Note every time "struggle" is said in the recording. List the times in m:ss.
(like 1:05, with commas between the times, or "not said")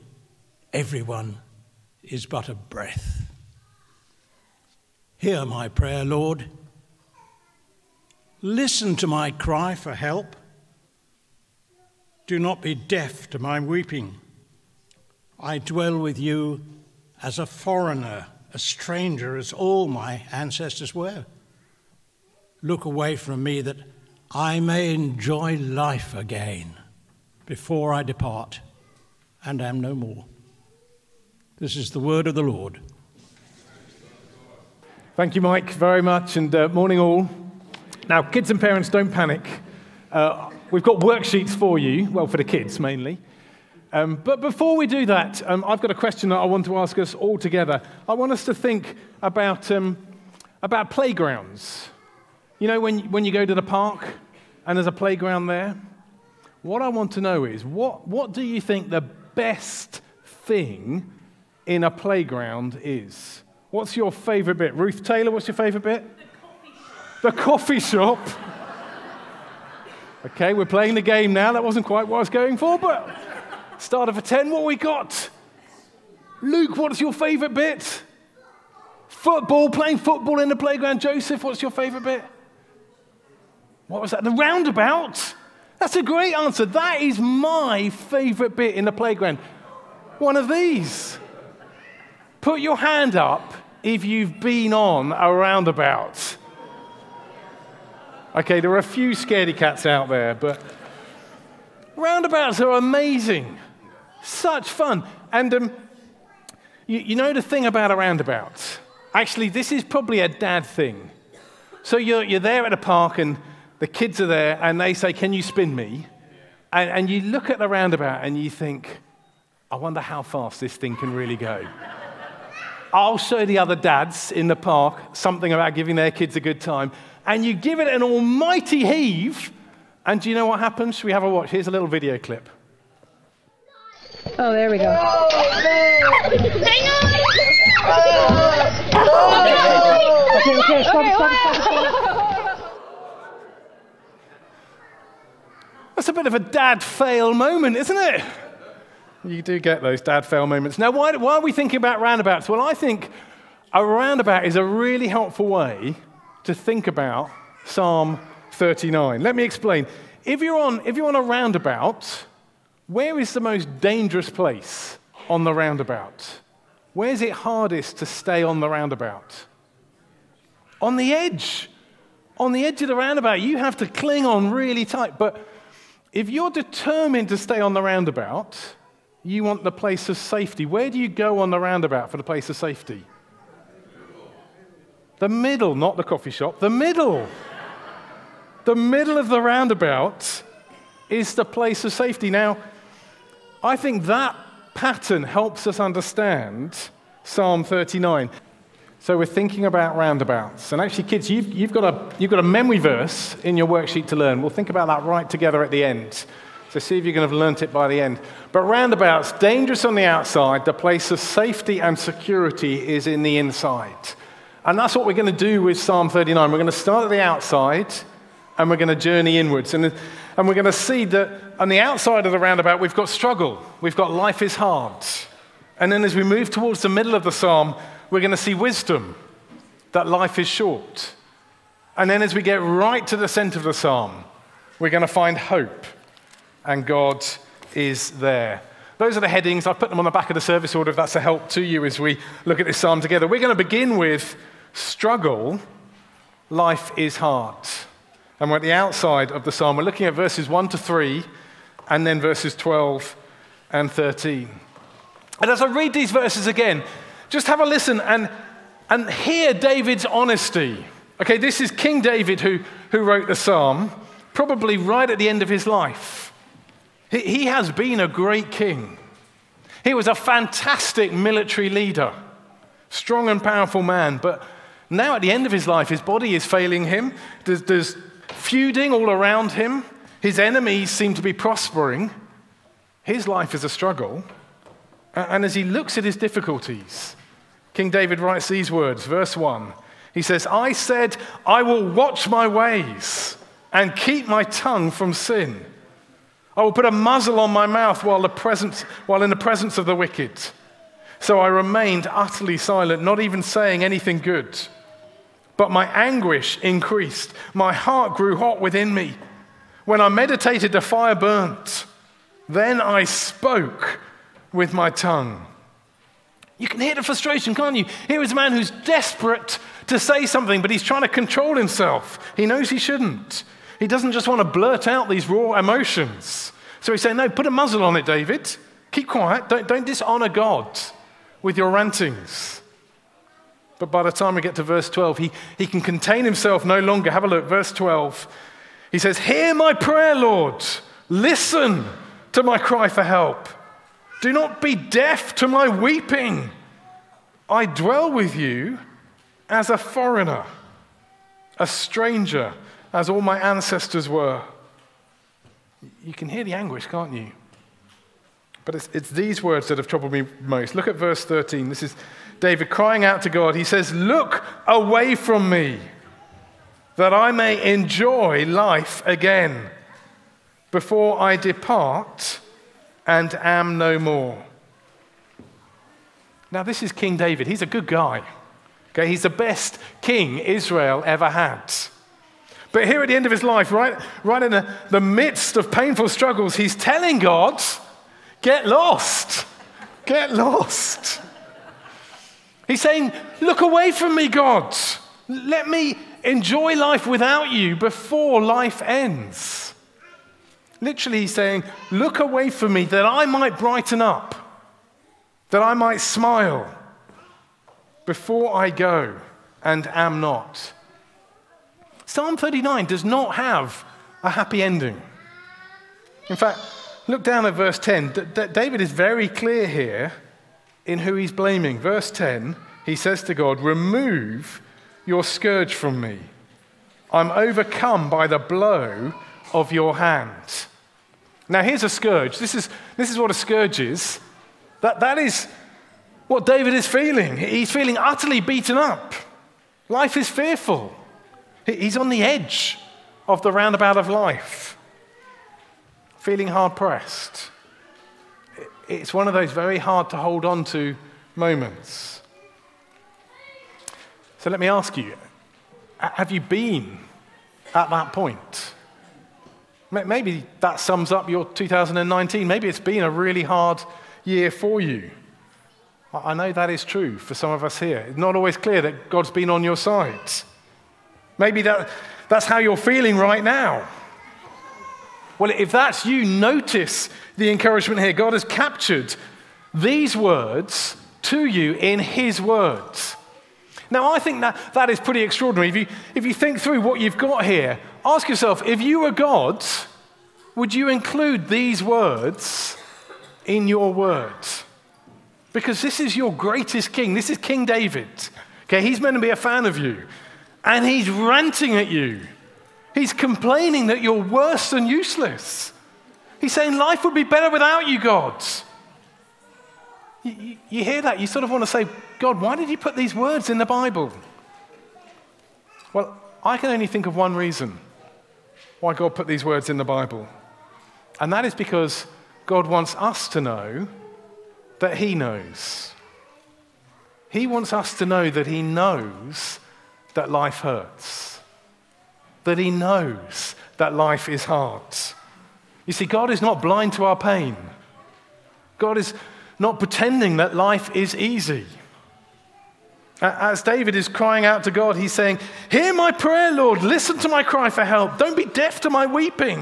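3:43, 4:04, 4:43, 6:26.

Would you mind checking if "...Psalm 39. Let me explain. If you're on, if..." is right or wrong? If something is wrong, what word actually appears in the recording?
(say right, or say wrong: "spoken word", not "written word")
right.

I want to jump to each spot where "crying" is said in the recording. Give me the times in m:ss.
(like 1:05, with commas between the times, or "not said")
6:02, 9:04.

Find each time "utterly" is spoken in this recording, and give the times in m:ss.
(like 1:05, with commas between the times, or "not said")
5:02, 7:17.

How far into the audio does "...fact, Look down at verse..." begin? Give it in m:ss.
6:56.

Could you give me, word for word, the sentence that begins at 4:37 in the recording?
There's, there's feuding all around him.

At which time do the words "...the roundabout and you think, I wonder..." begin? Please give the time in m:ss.
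1:57.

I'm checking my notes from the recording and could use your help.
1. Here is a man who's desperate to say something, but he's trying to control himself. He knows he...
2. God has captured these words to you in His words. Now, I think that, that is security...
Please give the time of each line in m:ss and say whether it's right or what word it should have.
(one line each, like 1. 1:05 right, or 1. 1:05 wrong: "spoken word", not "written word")
1. 5:18 right
2. 7:58 wrong: "pretty", not "security".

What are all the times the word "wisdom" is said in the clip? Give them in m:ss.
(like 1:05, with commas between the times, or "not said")
3:48.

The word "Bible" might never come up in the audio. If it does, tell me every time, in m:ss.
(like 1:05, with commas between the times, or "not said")
8:33, 8:39.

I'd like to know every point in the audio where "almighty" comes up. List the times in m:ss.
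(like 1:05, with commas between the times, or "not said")
2:08.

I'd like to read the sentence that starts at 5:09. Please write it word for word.
When I meditated, a fire burnt.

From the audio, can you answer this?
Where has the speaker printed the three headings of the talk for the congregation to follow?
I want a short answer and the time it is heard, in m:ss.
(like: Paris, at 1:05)
Back of the service order, at 4:00.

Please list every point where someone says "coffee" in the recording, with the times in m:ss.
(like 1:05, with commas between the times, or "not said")
1:07, 3:06.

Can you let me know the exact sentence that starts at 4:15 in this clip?
And as I read these verses again, just have a listen and, and hear David's honesty.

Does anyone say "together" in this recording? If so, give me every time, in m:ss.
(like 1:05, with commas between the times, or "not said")
0:47, 3:25, 4:02.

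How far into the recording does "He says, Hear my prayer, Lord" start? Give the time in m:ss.
5:38.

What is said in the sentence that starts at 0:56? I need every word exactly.
What I want to know is what, what do you think the best thing in a playground is?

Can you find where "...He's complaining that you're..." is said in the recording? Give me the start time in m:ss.
8:22.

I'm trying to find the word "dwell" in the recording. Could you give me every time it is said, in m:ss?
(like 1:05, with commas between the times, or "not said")
0:15, 5:47.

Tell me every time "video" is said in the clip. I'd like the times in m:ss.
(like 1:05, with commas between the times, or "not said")
2:11.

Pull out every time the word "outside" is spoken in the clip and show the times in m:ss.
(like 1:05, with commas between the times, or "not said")
3:30, 3:37, 3:41, 4:08.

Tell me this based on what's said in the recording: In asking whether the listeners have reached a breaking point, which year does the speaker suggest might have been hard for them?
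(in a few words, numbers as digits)
2019.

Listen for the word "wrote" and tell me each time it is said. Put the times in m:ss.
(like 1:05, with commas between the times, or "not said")
4:22.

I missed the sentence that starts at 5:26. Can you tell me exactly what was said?
So he's saying, No, put a muzzle on it, David.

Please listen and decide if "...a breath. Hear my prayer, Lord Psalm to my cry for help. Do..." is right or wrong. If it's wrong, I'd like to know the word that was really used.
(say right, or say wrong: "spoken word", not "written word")
wrong: "Listen", not "Psalm".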